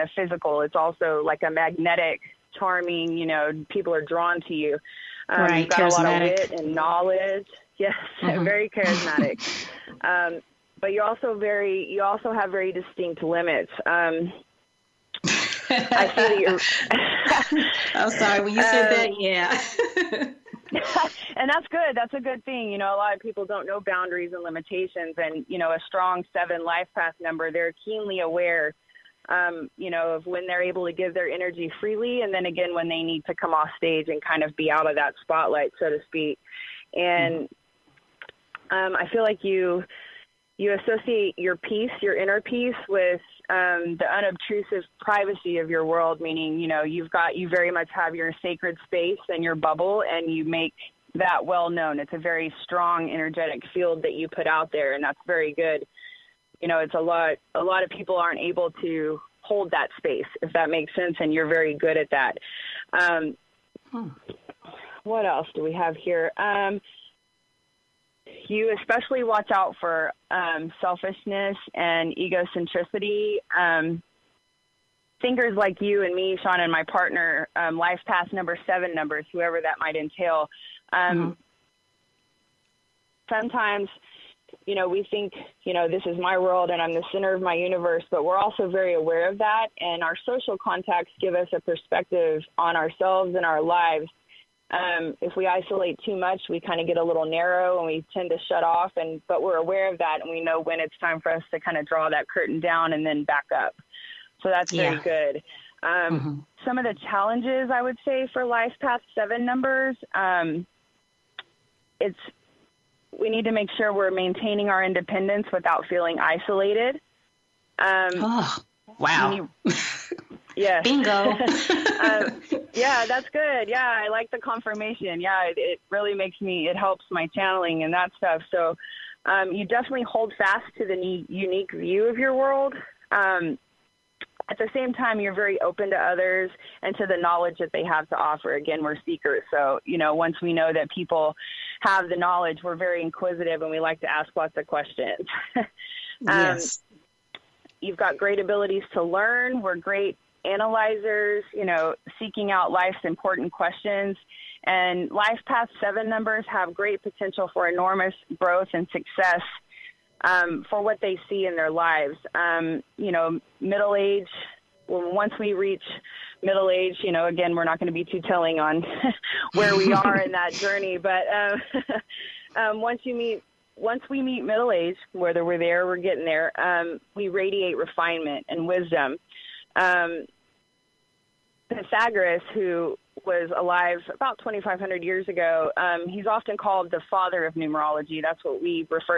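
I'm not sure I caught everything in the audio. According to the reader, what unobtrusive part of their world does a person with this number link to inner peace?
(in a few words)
privacy.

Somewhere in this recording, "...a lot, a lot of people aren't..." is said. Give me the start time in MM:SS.
00:56.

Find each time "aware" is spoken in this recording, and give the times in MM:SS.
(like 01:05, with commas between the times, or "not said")
00:28, 01:28, 01:39.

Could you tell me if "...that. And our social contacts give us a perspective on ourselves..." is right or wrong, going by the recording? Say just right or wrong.
right.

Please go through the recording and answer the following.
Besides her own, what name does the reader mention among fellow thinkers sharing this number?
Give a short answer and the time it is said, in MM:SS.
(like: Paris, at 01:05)
Sean, at 01:16.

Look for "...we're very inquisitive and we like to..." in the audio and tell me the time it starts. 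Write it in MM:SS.
02:22.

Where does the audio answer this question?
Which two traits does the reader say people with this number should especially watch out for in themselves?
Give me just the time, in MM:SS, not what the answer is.
01:10.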